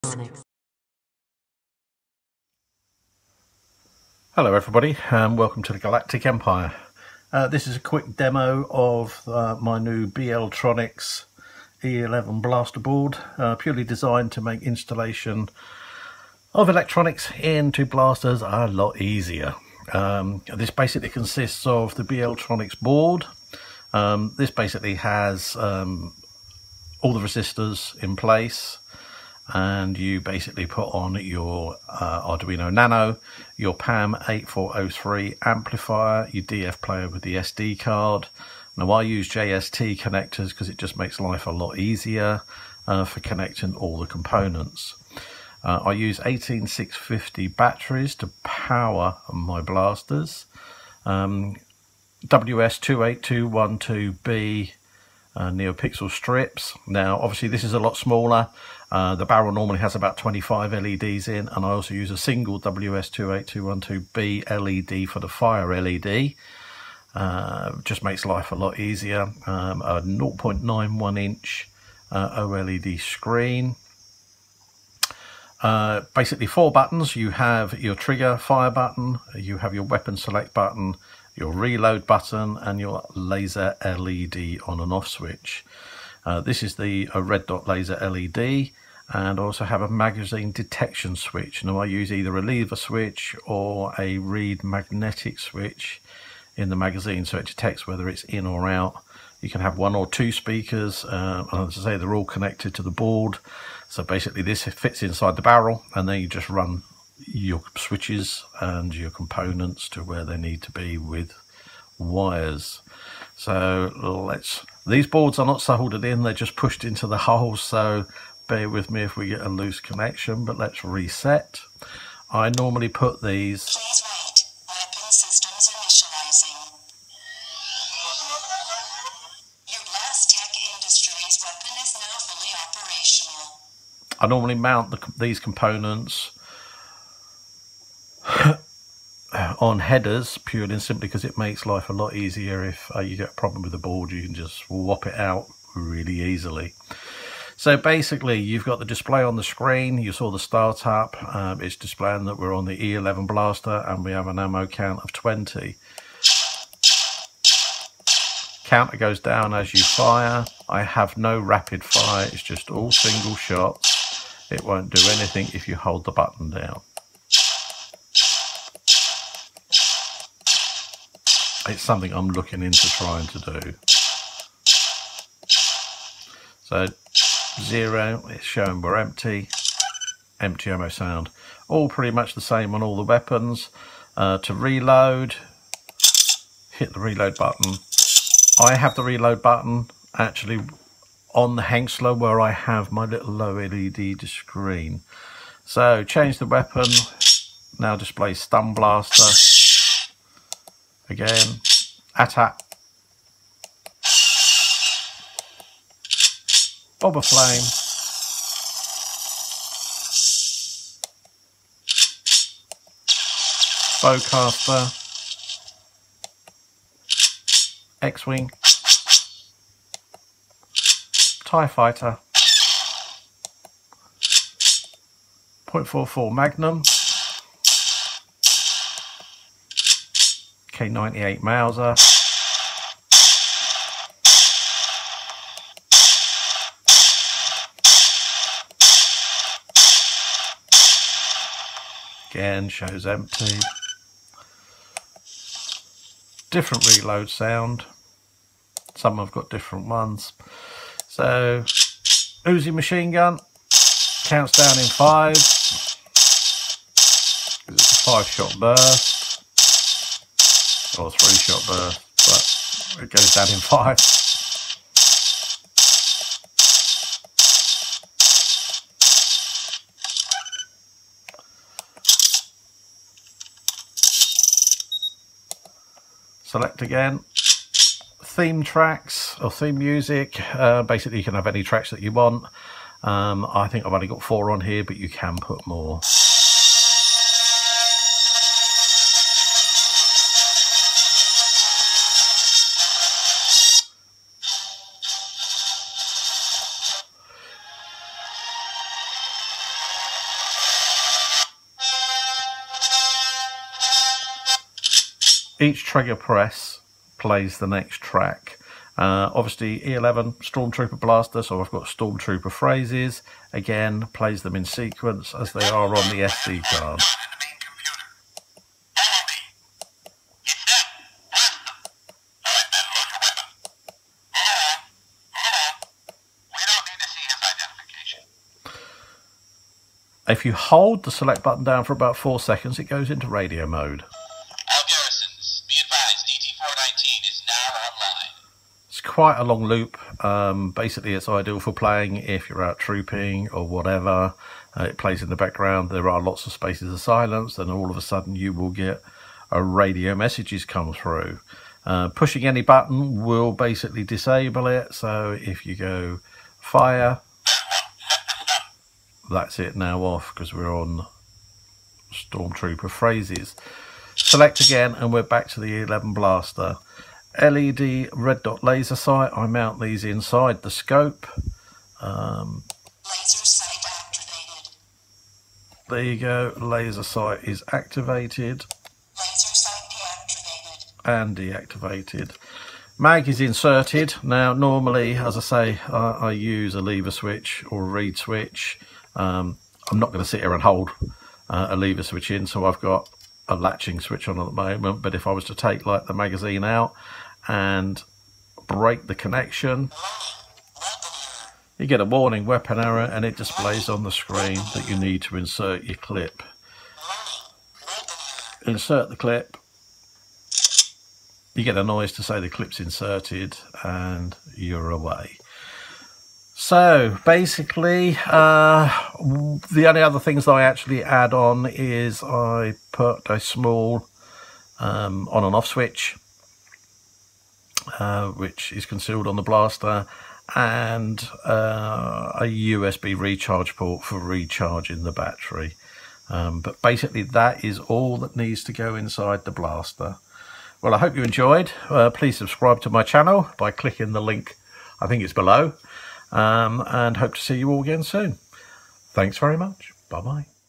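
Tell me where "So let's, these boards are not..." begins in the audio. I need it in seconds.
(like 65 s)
113 s.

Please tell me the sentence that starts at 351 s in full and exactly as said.
Uh, pushing any button will basically disable it.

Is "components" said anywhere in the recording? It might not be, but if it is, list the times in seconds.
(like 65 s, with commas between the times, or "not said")
44 s, 109 s, 135 s.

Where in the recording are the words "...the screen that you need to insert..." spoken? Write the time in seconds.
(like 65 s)
404 s.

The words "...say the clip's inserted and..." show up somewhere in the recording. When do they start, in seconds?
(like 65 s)
412 s.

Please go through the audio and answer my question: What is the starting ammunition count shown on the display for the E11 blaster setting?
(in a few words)
20.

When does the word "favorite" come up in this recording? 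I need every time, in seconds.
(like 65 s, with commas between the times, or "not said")
not said.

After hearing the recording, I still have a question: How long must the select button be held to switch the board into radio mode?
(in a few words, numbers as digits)
about 4 seconds.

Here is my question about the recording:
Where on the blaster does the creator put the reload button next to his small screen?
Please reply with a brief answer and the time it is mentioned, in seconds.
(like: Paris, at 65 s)
the Hengstler, at 191 s.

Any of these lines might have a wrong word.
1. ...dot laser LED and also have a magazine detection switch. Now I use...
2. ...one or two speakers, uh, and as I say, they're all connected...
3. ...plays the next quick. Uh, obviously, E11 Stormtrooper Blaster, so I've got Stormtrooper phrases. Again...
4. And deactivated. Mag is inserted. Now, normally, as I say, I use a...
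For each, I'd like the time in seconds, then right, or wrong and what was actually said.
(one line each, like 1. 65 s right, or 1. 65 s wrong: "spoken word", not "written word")
1. 87 s right
2. 99 s right
3. 307 s wrong: "track", not "quick"
4. 381 s right.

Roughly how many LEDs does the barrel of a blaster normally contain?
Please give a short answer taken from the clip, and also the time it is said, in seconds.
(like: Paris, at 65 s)
25, at 60 s.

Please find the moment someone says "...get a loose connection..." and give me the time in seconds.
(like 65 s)
119 s.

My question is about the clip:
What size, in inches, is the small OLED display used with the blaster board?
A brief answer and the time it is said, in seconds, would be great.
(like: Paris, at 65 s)
0.91 inch, at 70 s.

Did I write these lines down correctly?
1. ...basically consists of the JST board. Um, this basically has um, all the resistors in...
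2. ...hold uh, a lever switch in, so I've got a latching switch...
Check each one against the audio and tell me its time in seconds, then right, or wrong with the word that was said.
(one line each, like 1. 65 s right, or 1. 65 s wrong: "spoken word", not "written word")
1. 20 s wrong: "BLTroniX", not "JST"
2. 390 s right.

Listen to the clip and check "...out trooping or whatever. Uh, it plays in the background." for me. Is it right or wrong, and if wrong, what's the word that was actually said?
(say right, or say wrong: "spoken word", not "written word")
right.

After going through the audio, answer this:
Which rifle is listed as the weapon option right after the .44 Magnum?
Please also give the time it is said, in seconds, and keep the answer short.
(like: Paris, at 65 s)
98 Mauser, at 230 s.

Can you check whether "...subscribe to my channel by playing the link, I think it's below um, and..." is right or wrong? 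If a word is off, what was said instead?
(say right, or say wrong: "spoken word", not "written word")
wrong: "clicking", not "playing".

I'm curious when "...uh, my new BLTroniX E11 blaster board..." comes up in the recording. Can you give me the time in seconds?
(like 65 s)
9 s.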